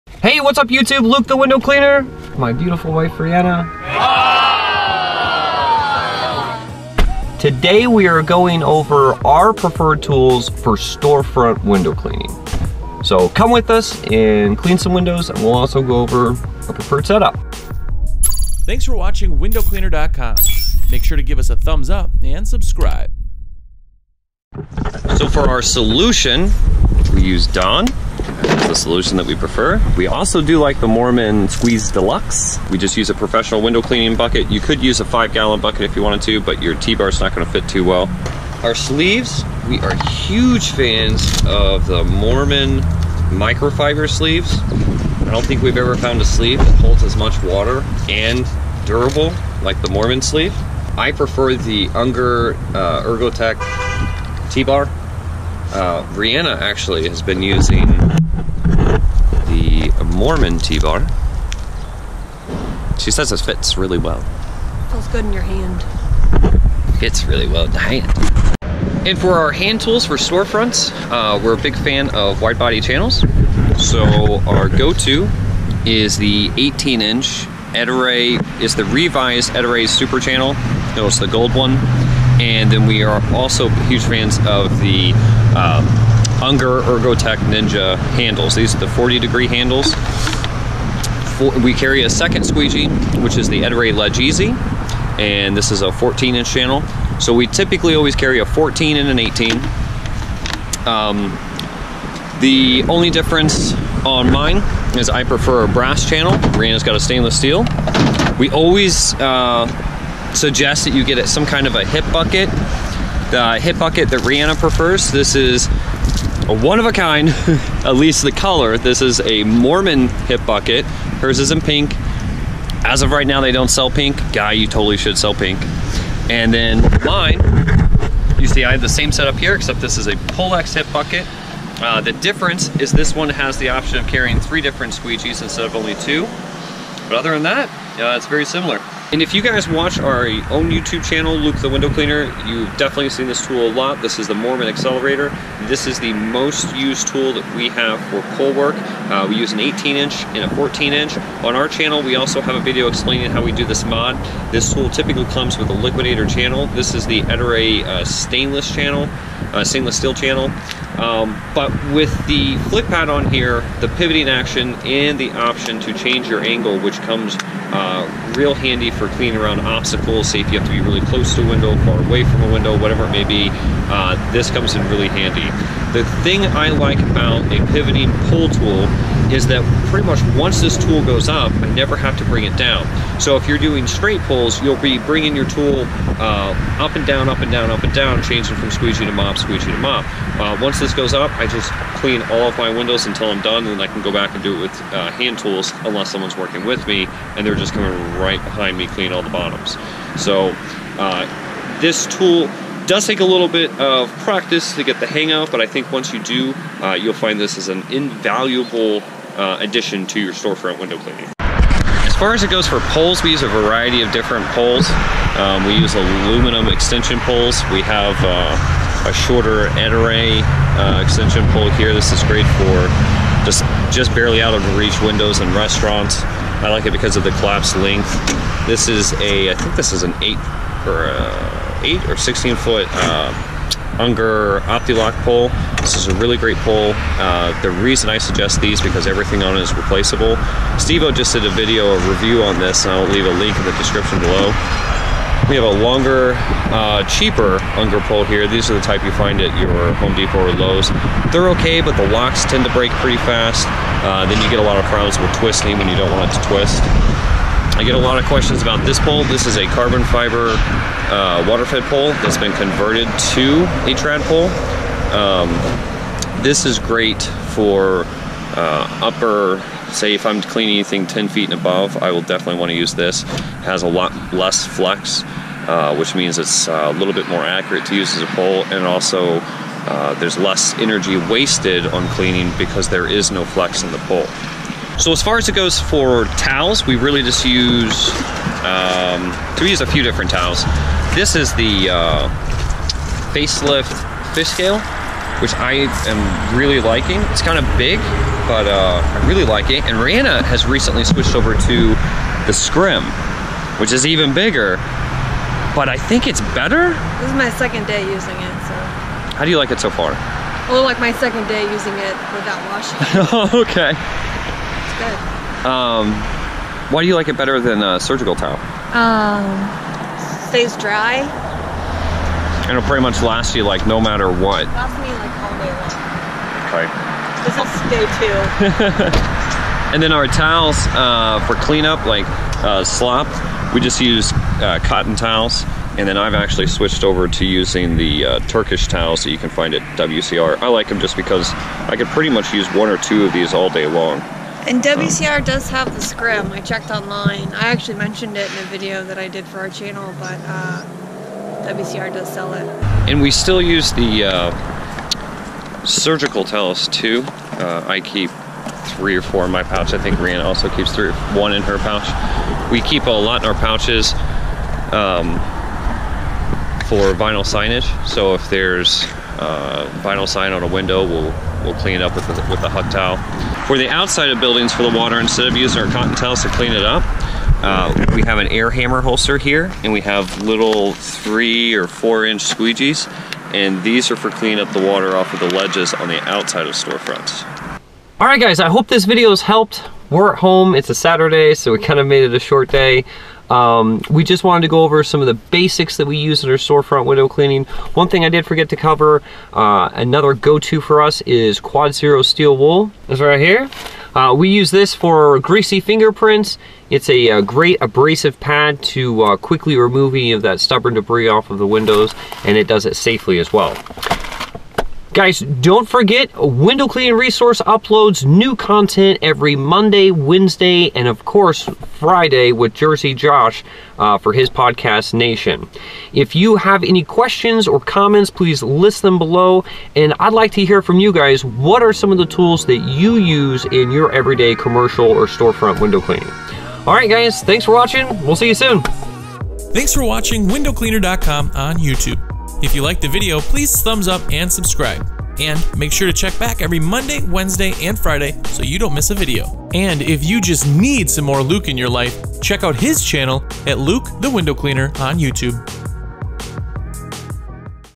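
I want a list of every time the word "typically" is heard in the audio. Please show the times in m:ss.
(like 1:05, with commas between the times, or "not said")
1:37, 2:34.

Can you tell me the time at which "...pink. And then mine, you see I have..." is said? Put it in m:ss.
2:05.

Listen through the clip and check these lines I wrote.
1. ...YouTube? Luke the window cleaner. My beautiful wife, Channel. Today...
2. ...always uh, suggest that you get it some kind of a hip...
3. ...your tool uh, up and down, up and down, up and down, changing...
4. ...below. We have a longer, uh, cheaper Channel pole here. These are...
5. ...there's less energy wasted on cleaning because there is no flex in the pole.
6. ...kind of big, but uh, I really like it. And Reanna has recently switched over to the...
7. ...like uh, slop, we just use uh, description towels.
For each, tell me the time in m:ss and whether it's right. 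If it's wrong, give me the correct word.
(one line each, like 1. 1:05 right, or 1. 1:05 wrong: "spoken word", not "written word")
1. 0:00 wrong: "Reanna", not "Channel"
2. 1:48 right
3. 3:05 right
4. 4:04 wrong: "Unger", not "Channel"
5. 4:40 right
6. 4:57 right
7. 5:32 wrong: "cotton", not "description".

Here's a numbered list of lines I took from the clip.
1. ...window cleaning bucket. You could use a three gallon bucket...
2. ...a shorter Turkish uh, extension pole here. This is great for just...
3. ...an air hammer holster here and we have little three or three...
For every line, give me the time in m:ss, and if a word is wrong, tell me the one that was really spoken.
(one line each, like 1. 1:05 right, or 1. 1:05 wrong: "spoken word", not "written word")
1. 0:33 wrong: "five", not "three"
2. 3:39 wrong: "Ettore", not "Turkish"
3. 6:18 wrong: "four", not "three".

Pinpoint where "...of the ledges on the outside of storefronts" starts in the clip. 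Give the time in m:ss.
6:25.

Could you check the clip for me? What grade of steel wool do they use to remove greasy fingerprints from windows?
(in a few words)
Quad Zero.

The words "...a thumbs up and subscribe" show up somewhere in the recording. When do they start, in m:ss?
0:21.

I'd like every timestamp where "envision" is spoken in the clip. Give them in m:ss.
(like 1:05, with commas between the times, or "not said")
not said.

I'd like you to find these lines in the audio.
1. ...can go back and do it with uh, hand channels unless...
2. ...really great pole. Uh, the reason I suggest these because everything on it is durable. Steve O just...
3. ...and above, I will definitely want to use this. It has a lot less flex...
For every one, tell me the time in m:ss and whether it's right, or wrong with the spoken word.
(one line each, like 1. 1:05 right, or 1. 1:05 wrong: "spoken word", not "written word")
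1. 3:13 wrong: "tools", not "channels"
2. 3:56 wrong: "replaceable", not "durable"
3. 4:31 right.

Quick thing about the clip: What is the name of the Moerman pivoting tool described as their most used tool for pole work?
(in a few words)
Moerman Excelerator.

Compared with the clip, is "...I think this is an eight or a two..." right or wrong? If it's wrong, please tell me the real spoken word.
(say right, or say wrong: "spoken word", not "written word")
wrong: "eight", not "two".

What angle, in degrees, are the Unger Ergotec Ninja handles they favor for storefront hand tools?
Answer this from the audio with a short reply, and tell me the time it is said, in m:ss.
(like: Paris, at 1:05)
40 degree, at 1:28.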